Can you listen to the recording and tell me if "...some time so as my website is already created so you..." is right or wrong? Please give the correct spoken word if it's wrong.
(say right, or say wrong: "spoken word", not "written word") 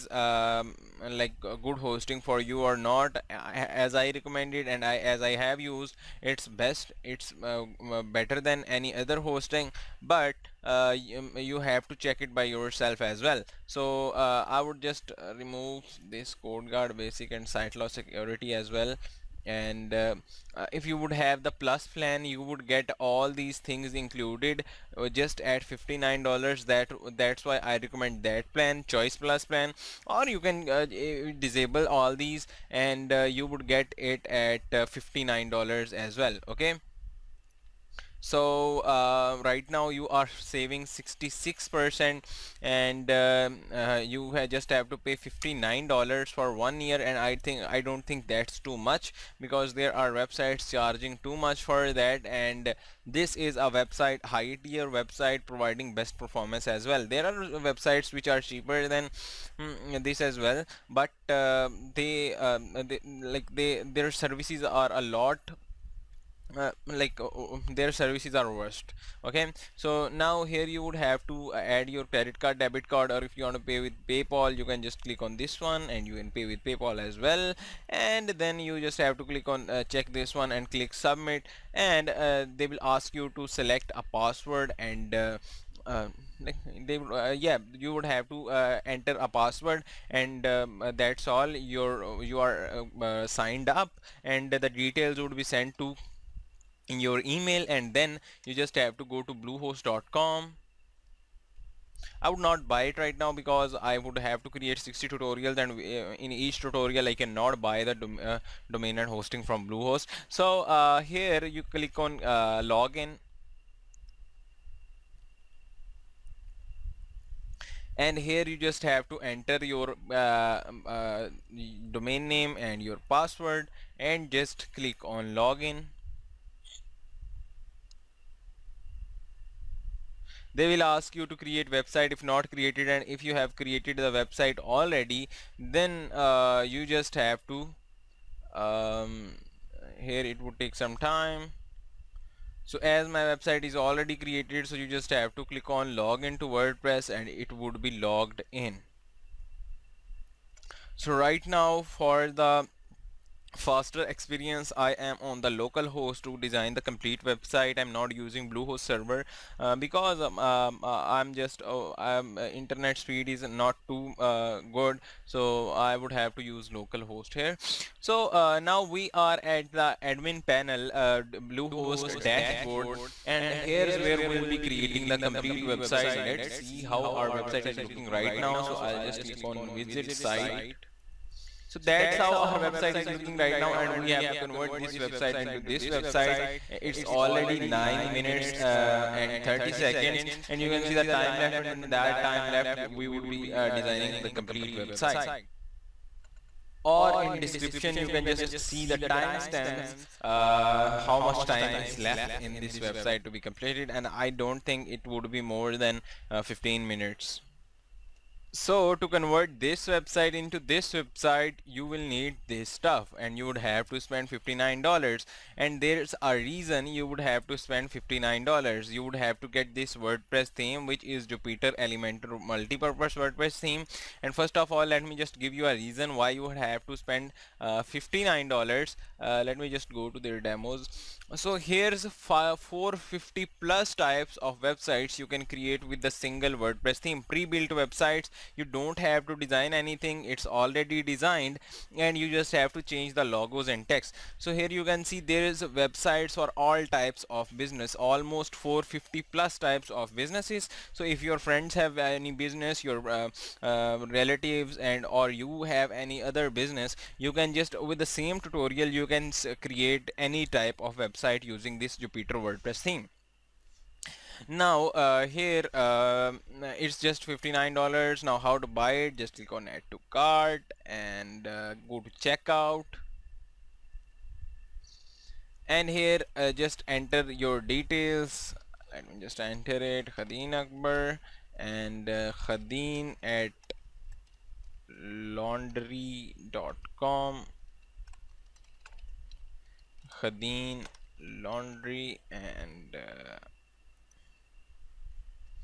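right.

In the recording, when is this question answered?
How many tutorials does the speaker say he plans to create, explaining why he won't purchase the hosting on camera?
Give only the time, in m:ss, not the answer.
1:44.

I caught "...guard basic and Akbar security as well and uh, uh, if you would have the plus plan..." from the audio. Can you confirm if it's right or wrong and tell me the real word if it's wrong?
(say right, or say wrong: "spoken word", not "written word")
wrong: "SiteLock", not "Akbar".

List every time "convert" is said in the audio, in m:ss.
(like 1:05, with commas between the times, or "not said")
3:04, 3:29.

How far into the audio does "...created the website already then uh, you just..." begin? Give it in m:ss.
2:13.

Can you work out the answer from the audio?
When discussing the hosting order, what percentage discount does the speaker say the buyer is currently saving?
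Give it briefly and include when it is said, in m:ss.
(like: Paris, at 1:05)
66%, at 0:40.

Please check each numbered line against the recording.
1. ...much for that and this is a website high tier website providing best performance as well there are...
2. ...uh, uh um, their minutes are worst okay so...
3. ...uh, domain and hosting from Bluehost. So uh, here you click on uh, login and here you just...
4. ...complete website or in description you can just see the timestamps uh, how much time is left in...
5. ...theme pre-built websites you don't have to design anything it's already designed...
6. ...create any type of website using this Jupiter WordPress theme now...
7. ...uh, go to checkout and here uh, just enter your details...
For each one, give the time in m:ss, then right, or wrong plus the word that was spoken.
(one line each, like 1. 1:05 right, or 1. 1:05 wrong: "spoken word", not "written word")
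1. 0:51 right
2. 1:07 wrong: "services", not "minutes"
3. 1:48 right
4. 3:14 right
5. 3:56 right
6. 4:19 right
7. 4:31 right.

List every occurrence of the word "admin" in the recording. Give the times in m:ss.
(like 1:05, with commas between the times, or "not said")
2:50.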